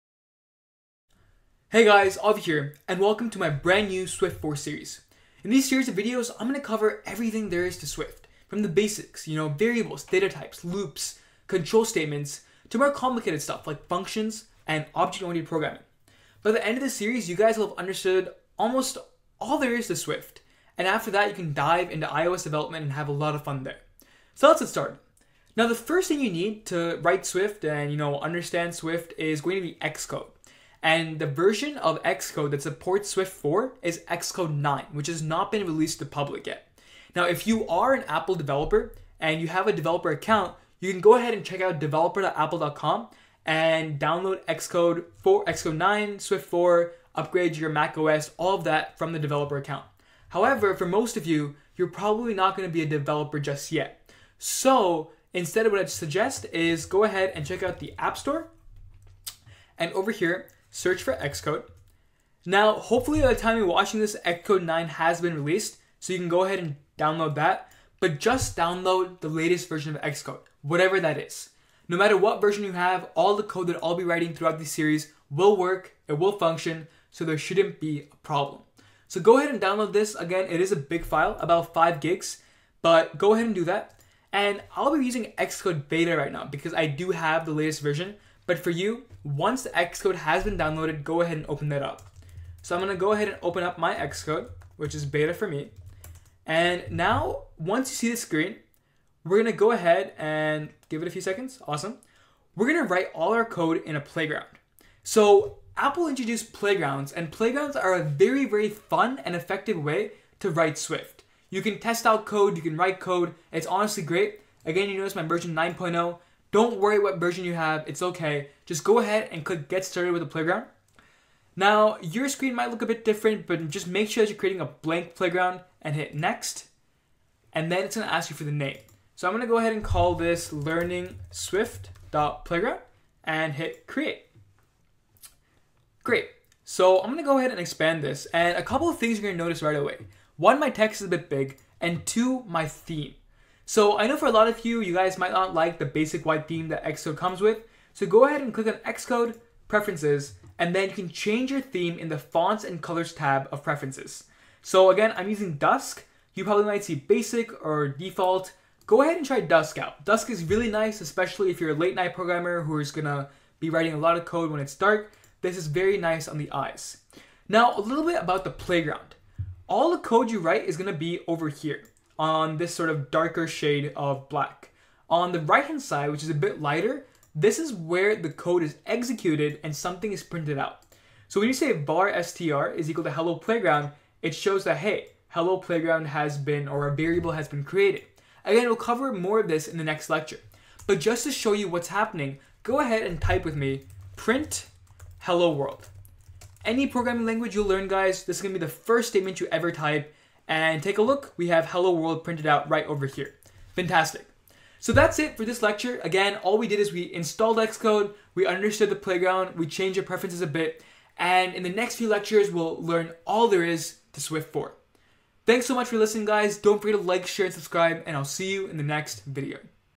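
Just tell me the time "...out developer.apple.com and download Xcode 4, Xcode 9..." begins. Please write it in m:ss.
0:41.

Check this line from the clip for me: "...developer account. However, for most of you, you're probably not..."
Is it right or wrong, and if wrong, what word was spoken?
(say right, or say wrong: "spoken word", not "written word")
right.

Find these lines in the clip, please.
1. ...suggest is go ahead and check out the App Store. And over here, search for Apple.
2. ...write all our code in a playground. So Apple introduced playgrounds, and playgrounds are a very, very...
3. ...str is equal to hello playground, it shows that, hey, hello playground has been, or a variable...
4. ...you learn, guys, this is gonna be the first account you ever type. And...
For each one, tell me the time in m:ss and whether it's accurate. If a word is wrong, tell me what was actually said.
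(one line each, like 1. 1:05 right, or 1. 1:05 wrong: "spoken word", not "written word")
1. 0:55 wrong: "Xcode", not "Apple"
2. 1:42 right
3. 3:02 right
4. 3:17 wrong: "statement", not "account".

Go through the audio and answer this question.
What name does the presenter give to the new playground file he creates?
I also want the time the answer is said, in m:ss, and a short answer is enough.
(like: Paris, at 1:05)
learning swift.playground, at 2:10.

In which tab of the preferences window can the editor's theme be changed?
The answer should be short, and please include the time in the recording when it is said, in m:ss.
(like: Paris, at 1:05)
Fonts and Colors, at 2:32.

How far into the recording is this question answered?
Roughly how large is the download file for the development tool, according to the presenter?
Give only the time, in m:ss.
1:21.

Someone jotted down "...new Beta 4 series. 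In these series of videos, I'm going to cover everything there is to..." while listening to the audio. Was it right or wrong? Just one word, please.
wrong.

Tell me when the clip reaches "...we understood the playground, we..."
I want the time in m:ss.
3:28.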